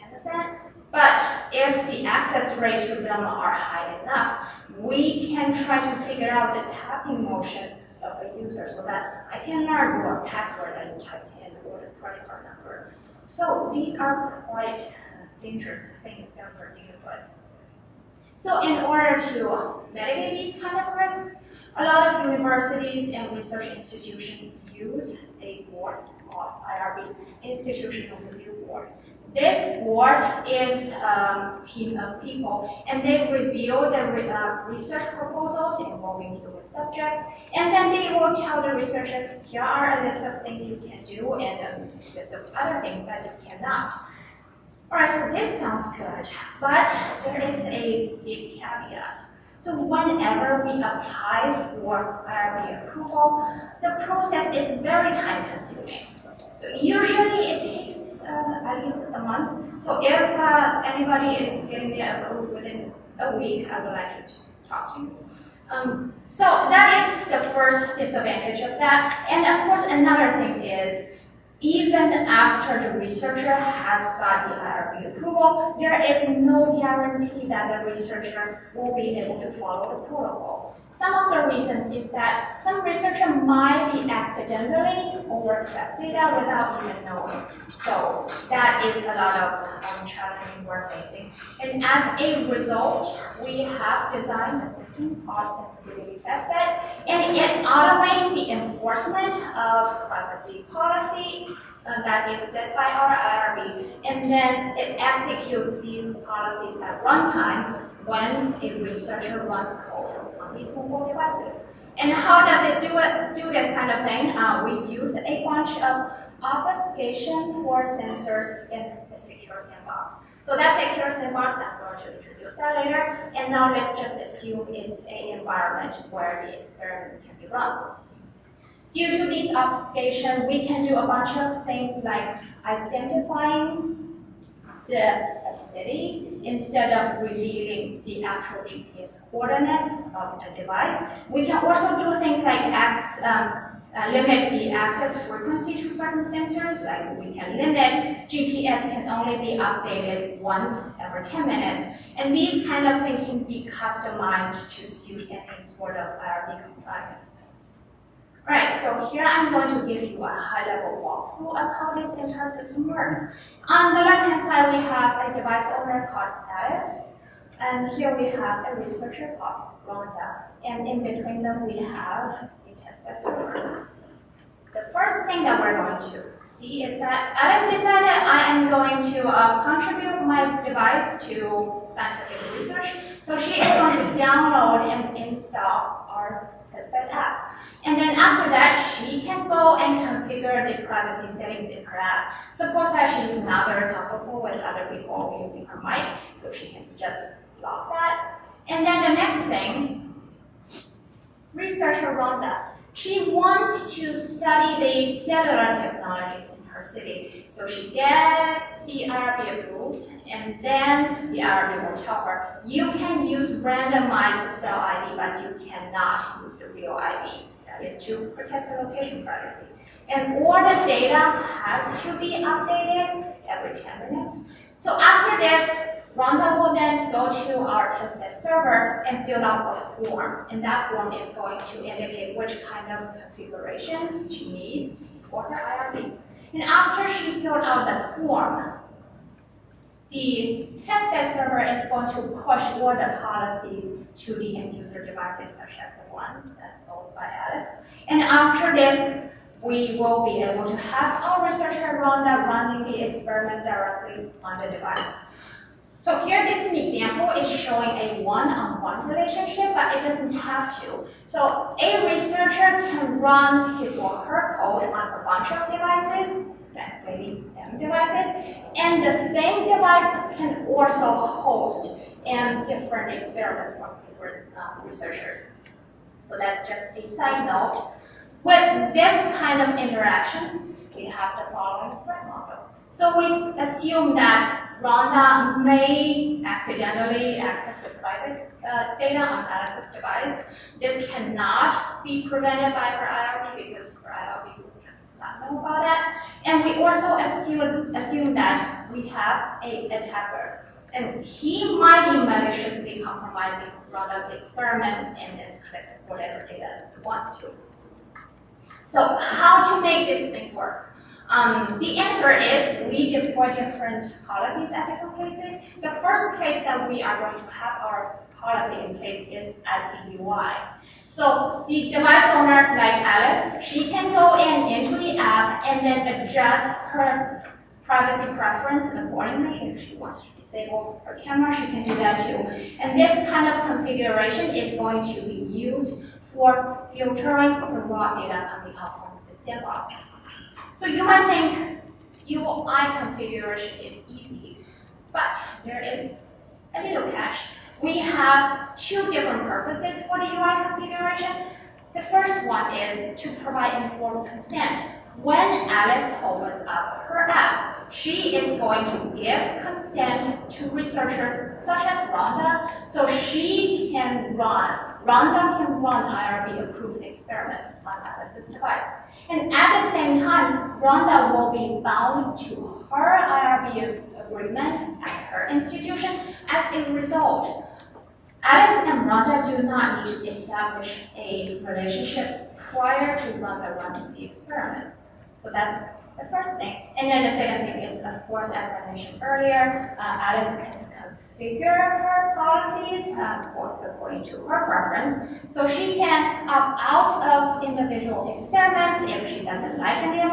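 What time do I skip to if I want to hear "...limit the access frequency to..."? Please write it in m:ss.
2:24.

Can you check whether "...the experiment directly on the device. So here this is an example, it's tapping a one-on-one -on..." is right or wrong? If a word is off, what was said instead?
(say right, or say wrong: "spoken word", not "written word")
wrong: "showing", not "tapping".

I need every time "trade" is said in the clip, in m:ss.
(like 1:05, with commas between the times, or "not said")
not said.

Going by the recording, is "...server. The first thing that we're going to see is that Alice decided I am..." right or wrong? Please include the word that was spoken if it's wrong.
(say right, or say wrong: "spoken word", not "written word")
right.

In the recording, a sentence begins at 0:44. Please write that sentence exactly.
Alright, so this sounds good, but there is a big caveat.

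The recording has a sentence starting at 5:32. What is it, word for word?
And this kind of configuration is going to be used for filtering the raw data on the output of the sandbox.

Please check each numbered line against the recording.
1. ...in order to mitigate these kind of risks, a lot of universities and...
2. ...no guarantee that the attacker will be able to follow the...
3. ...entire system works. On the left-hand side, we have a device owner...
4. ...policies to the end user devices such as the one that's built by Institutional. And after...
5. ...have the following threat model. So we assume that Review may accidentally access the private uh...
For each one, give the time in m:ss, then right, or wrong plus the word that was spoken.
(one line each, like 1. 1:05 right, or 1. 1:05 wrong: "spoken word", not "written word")
1. 0:18 right
2. 1:16 wrong: "researcher", not "attacker"
3. 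2:42 right
4. 4:03 wrong: "Alice", not "Institutional"
5. 4:41 wrong: "Rhonda", not "Review".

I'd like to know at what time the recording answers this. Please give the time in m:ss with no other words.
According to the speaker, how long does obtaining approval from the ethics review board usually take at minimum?
0:58.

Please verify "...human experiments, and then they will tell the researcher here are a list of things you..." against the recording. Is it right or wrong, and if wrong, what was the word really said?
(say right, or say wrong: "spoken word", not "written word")
wrong: "subjects", not "experiments".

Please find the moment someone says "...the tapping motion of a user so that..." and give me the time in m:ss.
0:06.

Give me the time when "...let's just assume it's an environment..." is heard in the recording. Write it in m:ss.
2:03.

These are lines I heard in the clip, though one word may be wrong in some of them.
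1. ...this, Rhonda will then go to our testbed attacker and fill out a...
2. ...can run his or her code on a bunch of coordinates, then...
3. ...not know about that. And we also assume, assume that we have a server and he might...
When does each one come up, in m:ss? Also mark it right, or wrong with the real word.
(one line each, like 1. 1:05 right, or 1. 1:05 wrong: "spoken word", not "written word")
1. 3:45 wrong: "server", not "attacker"
2. 4:22 wrong: "devices", not "coordinates"
3. 4:55 wrong: "attacker", not "server".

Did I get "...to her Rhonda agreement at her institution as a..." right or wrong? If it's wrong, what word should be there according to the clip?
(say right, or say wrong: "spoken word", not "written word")
wrong: "IRB", not "Rhonda".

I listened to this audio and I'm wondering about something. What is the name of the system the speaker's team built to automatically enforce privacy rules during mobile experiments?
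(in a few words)
Sensibility Testbed.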